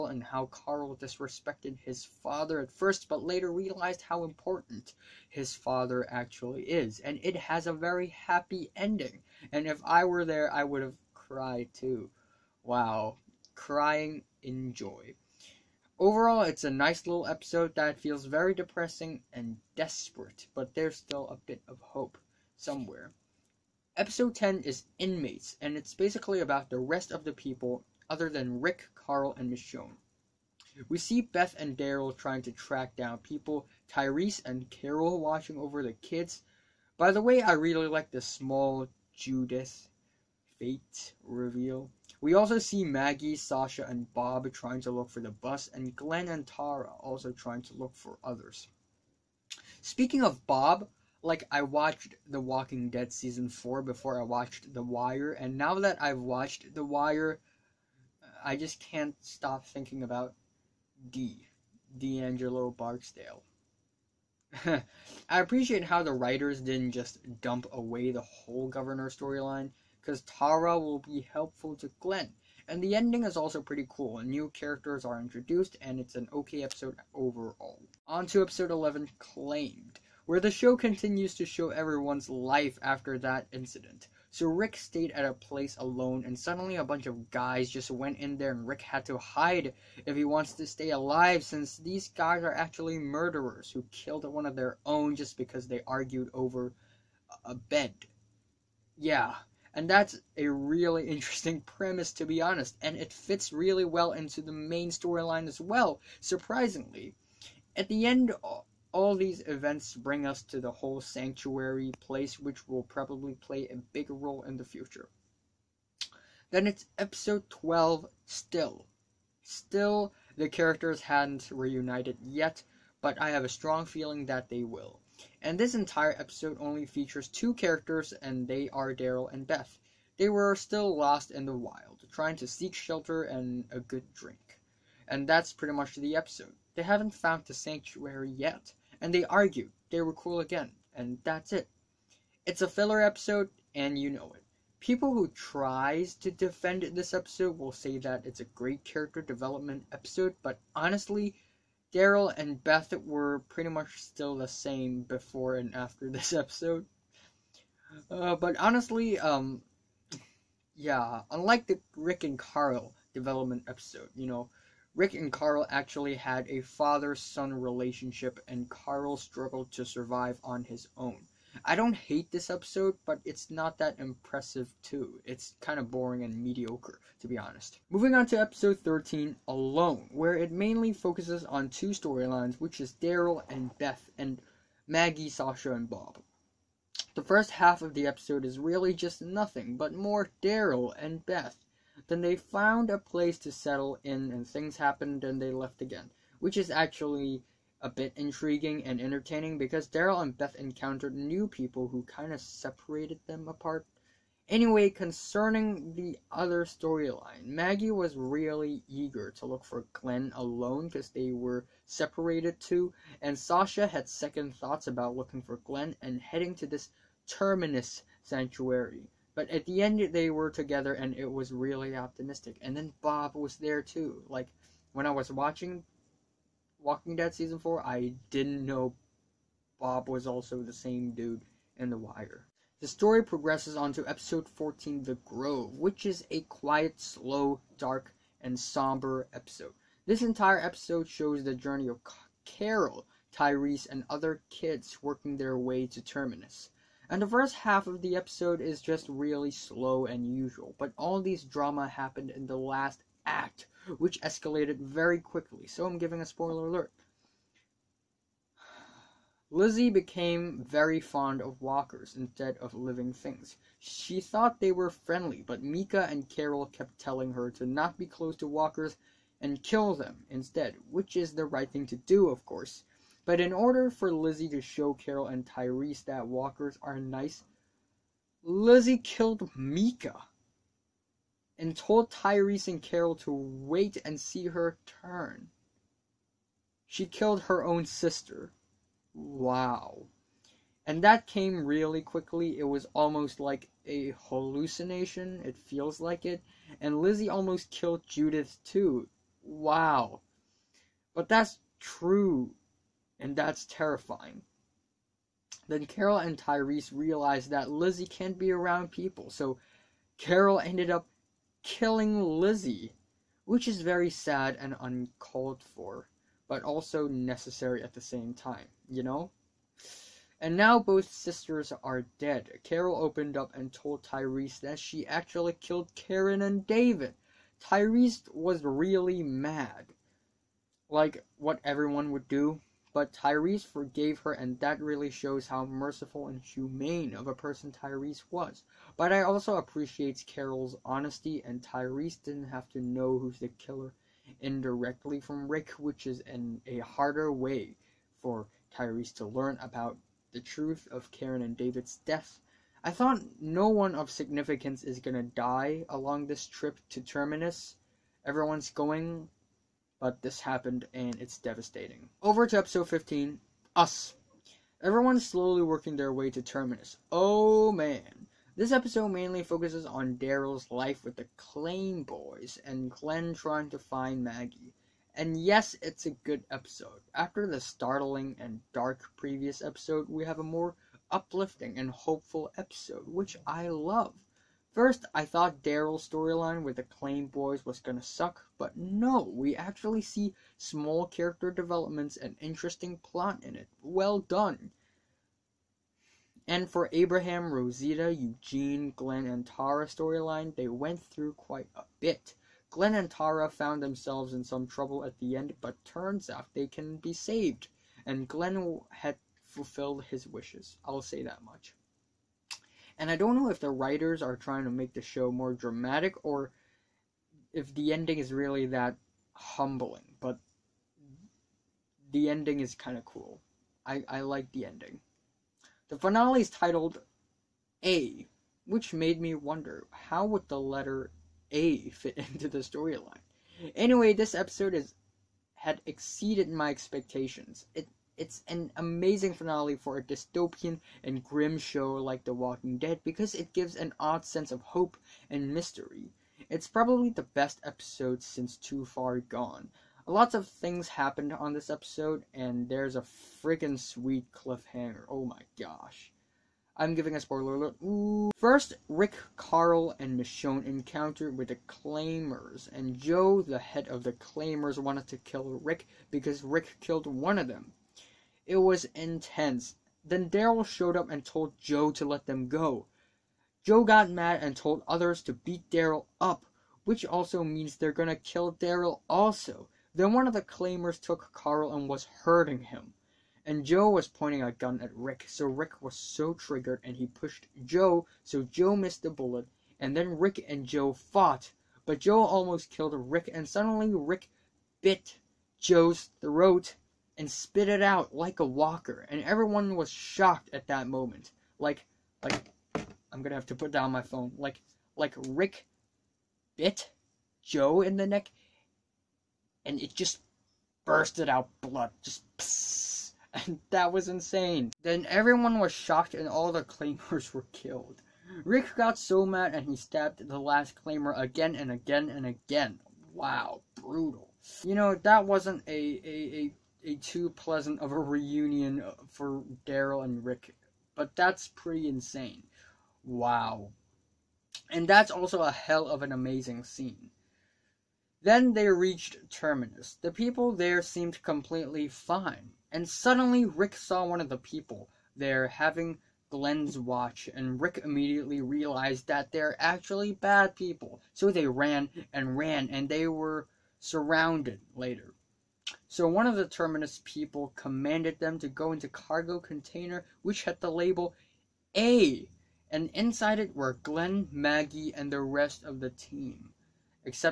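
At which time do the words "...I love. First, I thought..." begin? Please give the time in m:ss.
6:23.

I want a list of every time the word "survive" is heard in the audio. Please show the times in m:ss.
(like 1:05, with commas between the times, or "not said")
2:49.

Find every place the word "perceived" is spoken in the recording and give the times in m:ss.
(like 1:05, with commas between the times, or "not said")
not said.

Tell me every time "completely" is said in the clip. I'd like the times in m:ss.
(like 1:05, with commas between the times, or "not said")
9:01.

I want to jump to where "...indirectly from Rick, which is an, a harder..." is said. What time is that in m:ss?
5:44.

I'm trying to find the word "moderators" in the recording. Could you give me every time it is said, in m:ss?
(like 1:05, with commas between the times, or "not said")
not said.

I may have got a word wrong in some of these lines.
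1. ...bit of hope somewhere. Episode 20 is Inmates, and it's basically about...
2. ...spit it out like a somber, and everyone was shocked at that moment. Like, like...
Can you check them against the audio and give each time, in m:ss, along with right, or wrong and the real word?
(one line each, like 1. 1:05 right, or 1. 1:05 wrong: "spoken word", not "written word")
1. 0:21 wrong: "10", not "20"
2. 8:17 wrong: "walker", not "somber".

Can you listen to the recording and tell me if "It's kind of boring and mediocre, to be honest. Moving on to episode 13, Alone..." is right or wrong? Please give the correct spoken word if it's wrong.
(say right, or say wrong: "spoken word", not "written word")
right.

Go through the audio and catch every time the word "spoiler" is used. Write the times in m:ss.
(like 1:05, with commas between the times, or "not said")
4:16, 7:37.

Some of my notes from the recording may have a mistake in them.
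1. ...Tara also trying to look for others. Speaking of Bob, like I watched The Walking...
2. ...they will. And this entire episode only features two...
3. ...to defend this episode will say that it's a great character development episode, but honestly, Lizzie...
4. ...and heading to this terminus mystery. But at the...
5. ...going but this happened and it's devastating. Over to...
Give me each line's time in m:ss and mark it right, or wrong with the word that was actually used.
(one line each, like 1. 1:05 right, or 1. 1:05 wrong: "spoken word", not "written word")
1. 0:46 right
2. 2:04 right
3. 2:26 wrong: "Daryl", not "Lizzie"
4. 3:35 wrong: "sanctuary", not "mystery"
5. 5:58 right.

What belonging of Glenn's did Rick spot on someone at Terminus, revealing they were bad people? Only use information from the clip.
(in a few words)
Glenn's watch.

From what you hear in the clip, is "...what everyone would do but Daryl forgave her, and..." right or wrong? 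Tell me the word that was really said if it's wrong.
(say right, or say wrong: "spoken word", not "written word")
wrong: "Tyrese", not "Daryl".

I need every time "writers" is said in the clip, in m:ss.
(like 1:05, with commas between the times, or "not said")
1:06, 6:53.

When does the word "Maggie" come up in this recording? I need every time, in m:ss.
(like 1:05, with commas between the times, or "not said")
0:42, 3:04, 3:27, 6:14, 9:24.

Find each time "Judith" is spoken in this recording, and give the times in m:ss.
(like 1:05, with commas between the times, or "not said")
0:39, 4:58.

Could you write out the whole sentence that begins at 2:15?
And that's pretty much the episode.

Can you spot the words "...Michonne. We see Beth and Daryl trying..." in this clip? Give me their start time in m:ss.
0:29.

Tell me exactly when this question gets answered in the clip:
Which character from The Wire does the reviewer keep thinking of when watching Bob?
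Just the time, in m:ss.
1:01.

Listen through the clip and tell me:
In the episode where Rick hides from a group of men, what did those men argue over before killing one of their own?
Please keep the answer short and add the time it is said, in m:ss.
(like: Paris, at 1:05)
A bed, at 1:37.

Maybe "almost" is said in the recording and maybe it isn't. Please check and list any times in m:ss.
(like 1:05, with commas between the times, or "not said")
4:52, 4:57, 8:12.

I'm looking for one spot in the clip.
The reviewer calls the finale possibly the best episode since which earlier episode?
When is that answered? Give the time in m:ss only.
7:28.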